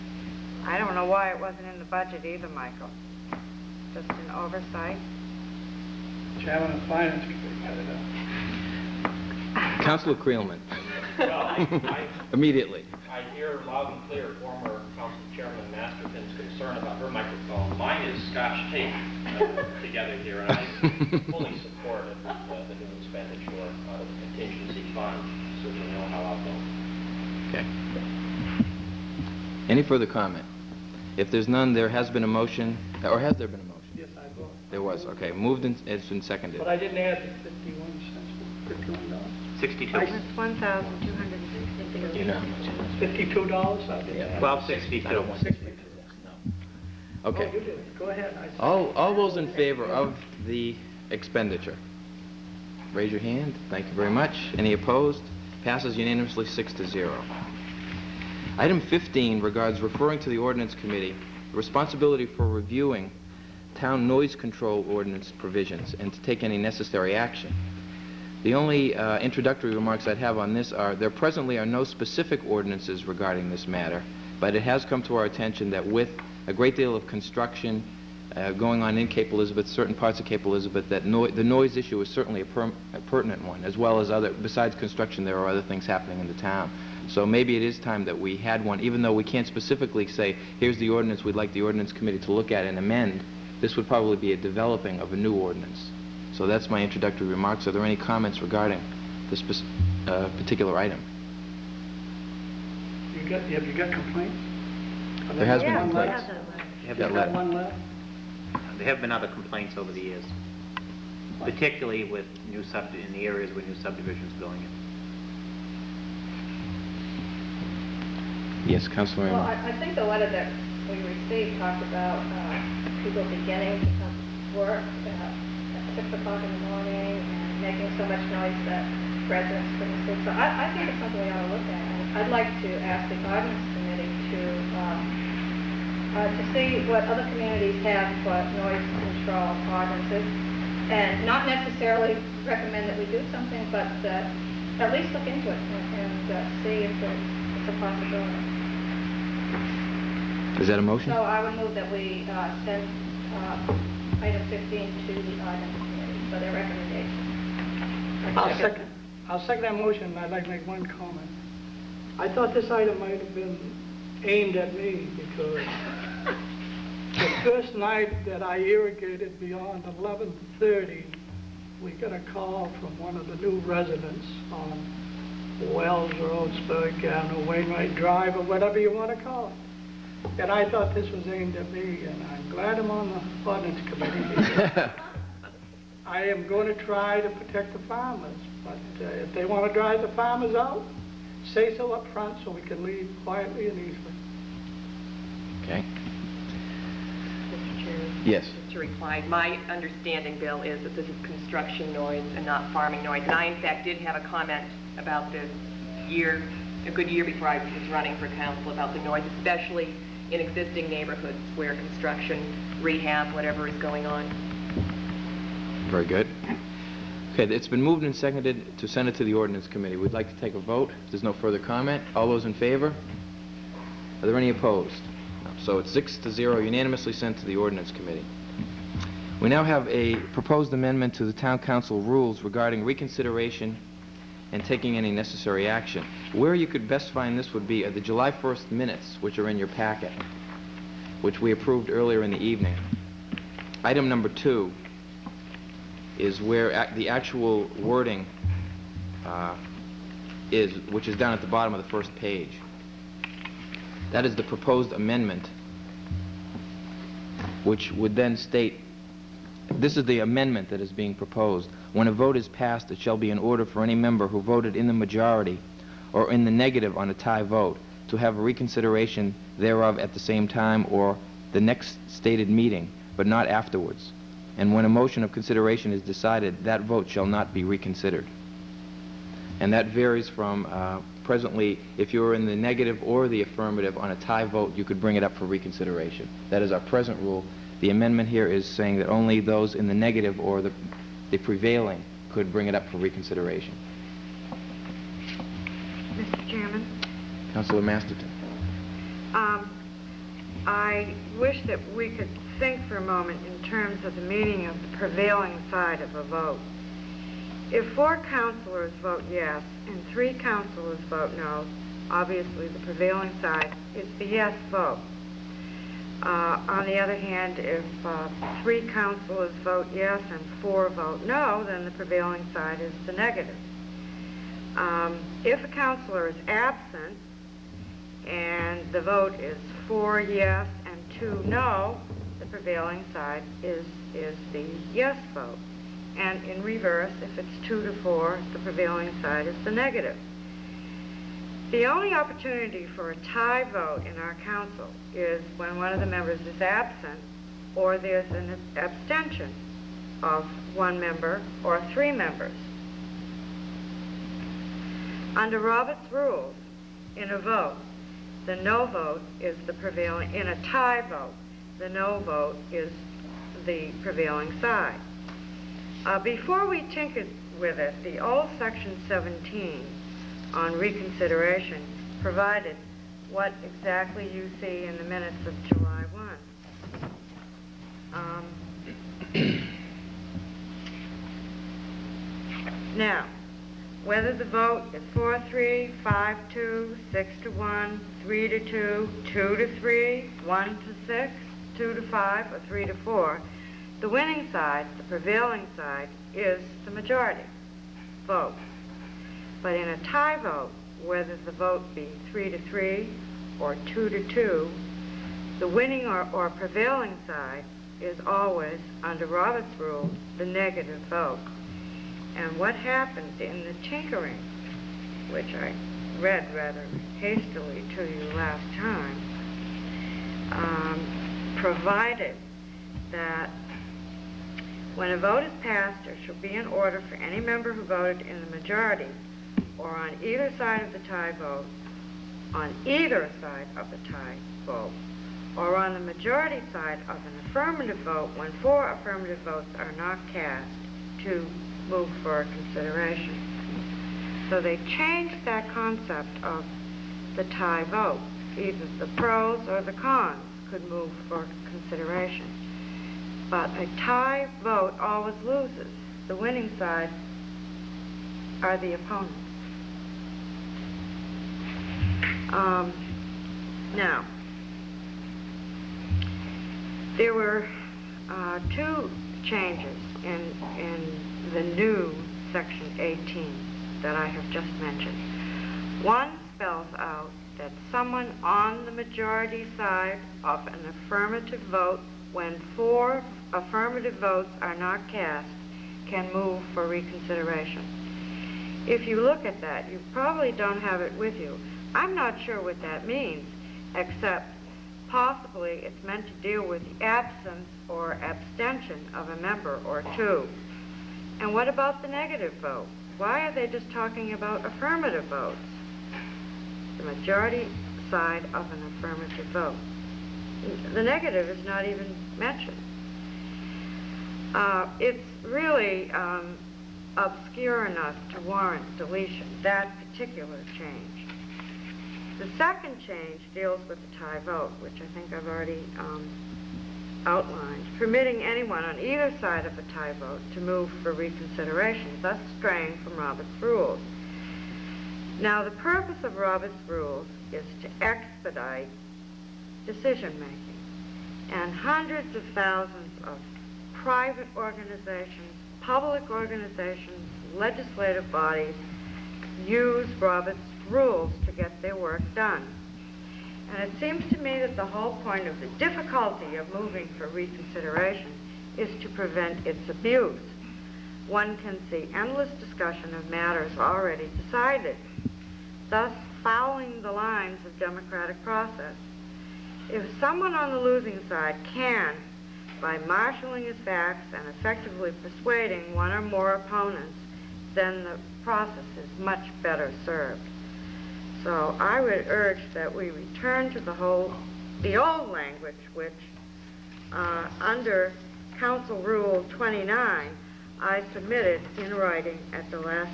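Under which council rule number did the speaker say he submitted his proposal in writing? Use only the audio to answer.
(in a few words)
Rule 29.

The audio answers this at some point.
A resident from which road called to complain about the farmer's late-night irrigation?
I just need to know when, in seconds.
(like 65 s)
175 s.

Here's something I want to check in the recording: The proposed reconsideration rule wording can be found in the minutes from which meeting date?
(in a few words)
July 1st.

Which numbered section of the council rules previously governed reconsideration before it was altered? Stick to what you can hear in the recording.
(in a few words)
Section 17.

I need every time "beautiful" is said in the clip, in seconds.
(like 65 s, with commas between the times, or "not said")
not said.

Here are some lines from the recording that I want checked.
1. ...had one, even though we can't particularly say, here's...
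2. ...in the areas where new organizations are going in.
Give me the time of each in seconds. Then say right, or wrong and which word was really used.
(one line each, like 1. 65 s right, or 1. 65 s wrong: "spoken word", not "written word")
1. 88 s wrong: "specifically", not "particularly"
2. 112 s wrong: "subdivisions", not "organizations".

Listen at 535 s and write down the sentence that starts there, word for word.
Now, the purpose of Robert's rules is to expedite decision-making.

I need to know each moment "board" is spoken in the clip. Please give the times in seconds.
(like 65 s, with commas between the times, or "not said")
not said.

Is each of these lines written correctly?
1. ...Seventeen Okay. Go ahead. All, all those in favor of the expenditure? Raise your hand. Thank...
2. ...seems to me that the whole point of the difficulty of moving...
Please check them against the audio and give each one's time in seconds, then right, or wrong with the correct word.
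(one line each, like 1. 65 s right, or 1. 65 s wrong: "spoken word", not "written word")
1. 45 s wrong: "Twelve", not "Seventeen"
2. 553 s right.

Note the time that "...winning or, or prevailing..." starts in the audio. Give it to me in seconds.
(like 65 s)
405 s.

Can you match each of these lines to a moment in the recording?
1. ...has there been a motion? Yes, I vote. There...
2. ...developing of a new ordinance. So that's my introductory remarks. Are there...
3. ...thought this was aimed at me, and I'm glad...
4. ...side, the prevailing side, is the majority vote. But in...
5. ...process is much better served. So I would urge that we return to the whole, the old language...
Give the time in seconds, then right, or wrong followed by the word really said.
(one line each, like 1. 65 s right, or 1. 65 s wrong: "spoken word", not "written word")
1. 33 s right
2. 94 s right
3. 180 s right
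4. 394 s right
5. 578 s right.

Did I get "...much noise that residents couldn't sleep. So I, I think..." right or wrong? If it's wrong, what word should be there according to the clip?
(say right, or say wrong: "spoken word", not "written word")
right.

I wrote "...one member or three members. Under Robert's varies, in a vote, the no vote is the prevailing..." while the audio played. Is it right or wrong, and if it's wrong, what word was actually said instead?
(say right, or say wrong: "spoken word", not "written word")
wrong: "rules", not "varies".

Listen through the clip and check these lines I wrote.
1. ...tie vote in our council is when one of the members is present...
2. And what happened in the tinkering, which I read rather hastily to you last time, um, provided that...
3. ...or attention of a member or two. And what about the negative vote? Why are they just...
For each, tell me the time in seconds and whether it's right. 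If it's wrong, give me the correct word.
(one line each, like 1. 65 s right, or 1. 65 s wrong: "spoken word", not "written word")
1. 343 s wrong: "absent", not "present"
2. 412 s right
3. 497 s wrong: "abstention", not "attention".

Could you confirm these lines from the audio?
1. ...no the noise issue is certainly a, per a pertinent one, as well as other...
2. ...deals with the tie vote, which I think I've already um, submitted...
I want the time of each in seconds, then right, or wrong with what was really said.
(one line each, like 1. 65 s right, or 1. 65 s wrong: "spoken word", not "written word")
1. 81 s right
2. 523 s wrong: "outlined", not "submitted".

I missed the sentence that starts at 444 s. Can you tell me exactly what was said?
So they changed that concept of the tie vote.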